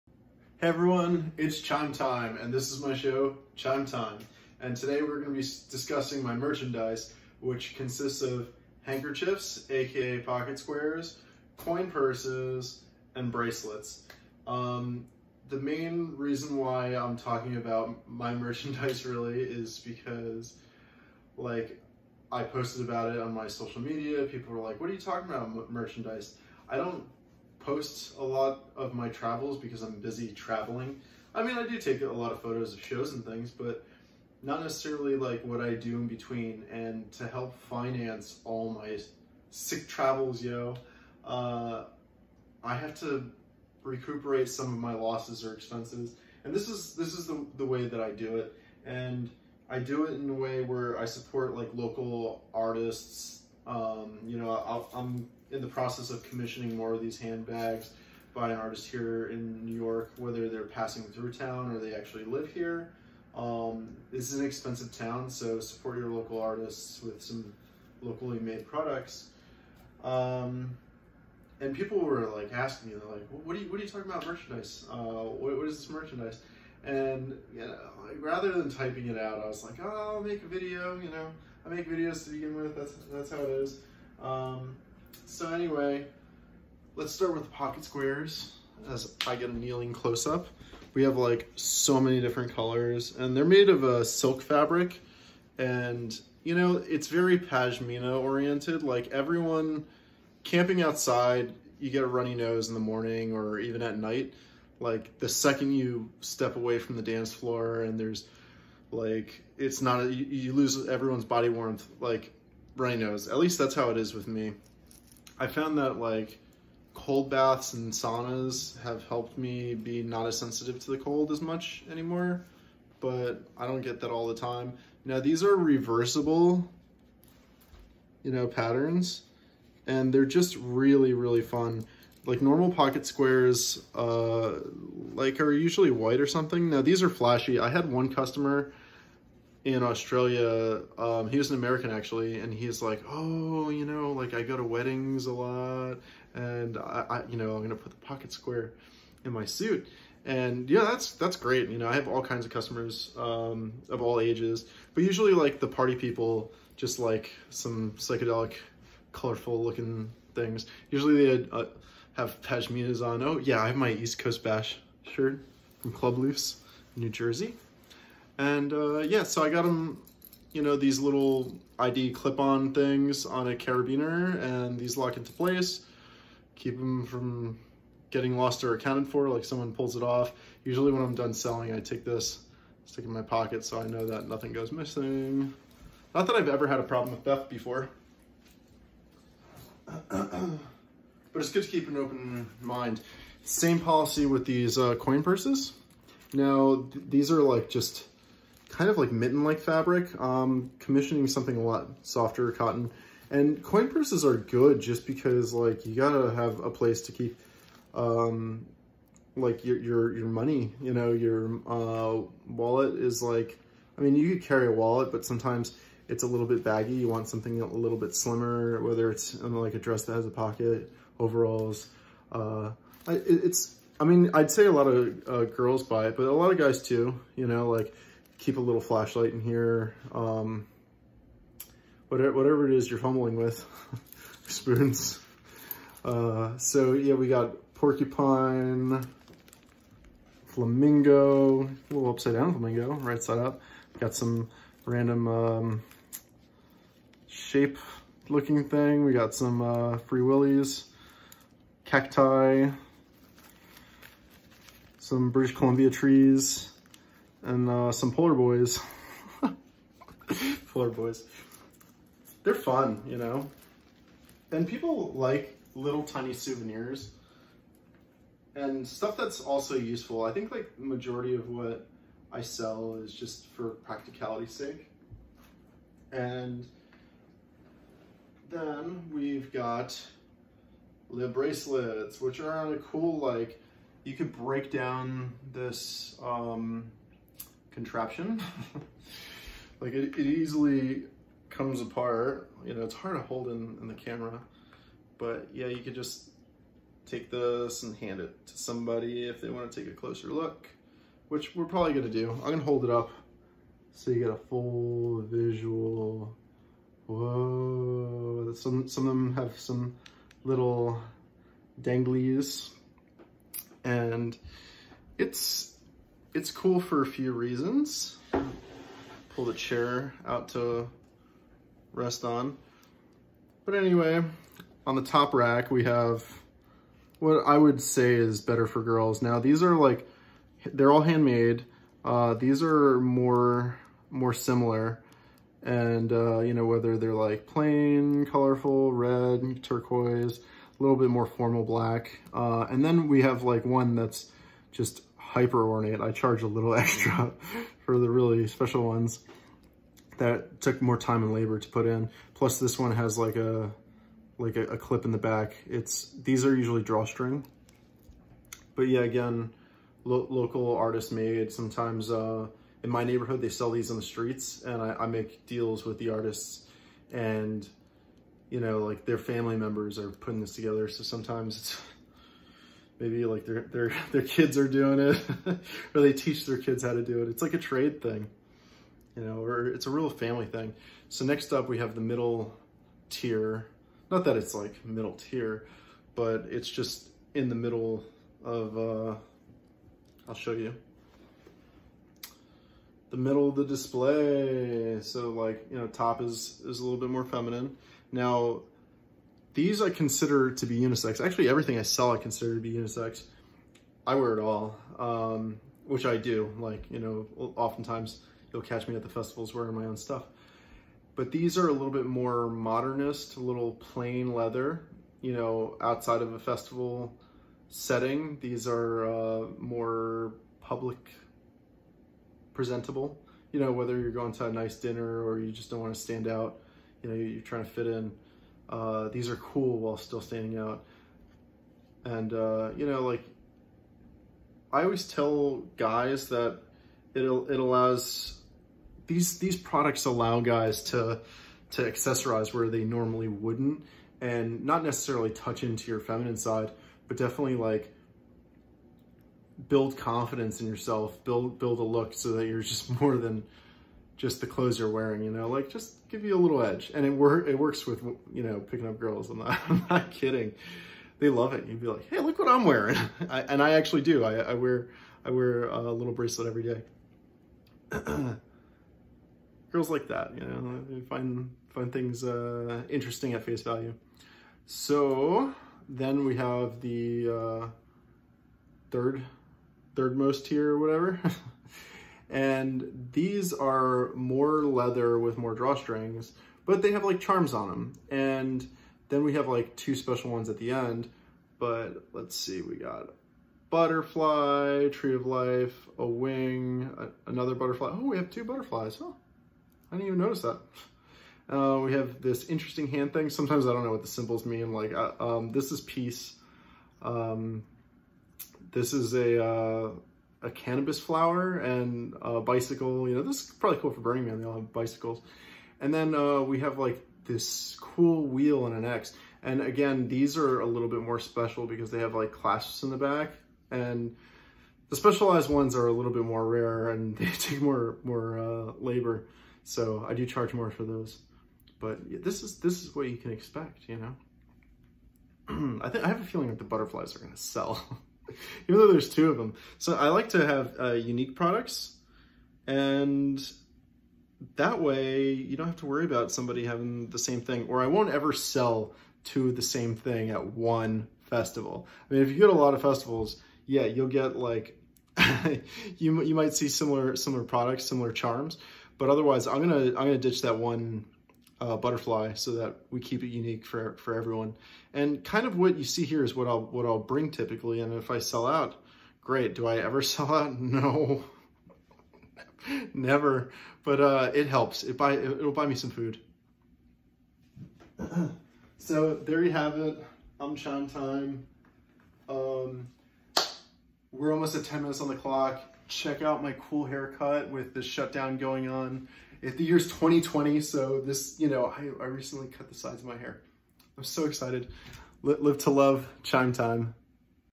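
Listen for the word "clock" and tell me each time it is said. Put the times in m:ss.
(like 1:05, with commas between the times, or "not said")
9:45.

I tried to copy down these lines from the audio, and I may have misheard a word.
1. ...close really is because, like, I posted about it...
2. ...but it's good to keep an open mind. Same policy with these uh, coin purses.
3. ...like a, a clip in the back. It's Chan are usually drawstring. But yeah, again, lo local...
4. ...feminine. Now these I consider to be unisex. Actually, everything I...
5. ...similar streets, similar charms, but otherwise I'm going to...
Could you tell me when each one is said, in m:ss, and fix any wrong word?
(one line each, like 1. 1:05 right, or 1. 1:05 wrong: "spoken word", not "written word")
1. 0:18 wrong: "merchandise", not "close"
2. 3:10 right
3. 5:54 wrong: "These", not "Chan"
4. 6:37 right
5. 9:17 wrong: "products", not "streets".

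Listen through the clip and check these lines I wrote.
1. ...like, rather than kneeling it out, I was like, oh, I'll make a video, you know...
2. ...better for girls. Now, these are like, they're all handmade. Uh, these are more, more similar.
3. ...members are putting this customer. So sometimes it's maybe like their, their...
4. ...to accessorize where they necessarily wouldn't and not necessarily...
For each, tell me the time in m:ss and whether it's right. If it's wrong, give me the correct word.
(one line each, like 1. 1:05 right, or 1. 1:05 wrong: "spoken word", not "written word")
1. 1:18 wrong: "typing", not "kneeling"
2. 5:28 right
3. 6:09 wrong: "together", not "customer"
4. 7:21 wrong: "normally", not "necessarily".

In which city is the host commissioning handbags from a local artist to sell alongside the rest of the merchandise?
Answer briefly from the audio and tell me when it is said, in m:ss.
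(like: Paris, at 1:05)
New York, at 0:59.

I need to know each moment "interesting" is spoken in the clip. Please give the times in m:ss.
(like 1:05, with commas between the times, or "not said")
7:52, 8:22.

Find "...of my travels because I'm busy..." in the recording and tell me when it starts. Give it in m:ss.
0:28.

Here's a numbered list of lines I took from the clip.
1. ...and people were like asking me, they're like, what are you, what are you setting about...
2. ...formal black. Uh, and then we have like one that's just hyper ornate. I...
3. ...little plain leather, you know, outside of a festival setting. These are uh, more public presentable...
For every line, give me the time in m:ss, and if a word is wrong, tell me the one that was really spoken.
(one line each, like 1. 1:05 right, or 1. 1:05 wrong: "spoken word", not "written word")
1. 1:11 wrong: "talking", not "setting"
2. 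5:41 right
3. 6:53 right.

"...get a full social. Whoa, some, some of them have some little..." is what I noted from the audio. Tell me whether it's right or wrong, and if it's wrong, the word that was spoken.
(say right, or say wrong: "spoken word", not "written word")
wrong: "visual", not "social".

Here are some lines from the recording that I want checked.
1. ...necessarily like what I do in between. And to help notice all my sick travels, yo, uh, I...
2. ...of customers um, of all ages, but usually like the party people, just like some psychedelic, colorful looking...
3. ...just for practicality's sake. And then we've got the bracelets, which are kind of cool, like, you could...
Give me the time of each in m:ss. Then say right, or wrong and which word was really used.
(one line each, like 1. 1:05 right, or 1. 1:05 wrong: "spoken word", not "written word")
1. 0:34 wrong: "finance", not "notice"
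2. 2:32 right
3. 4:33 right.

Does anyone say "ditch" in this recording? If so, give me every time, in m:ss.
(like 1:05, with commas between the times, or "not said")
9:20.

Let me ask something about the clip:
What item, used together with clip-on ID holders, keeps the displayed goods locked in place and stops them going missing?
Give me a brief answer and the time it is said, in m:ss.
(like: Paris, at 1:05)
Carabiner, at 2:53.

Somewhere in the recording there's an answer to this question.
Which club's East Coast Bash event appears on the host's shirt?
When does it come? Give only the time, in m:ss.
2:45.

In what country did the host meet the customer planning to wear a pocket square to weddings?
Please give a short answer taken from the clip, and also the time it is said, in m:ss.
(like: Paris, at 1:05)
Australia, at 2:19.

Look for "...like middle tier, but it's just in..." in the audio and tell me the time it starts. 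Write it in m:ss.
6:24.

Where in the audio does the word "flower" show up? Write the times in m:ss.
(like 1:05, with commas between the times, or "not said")
8:30.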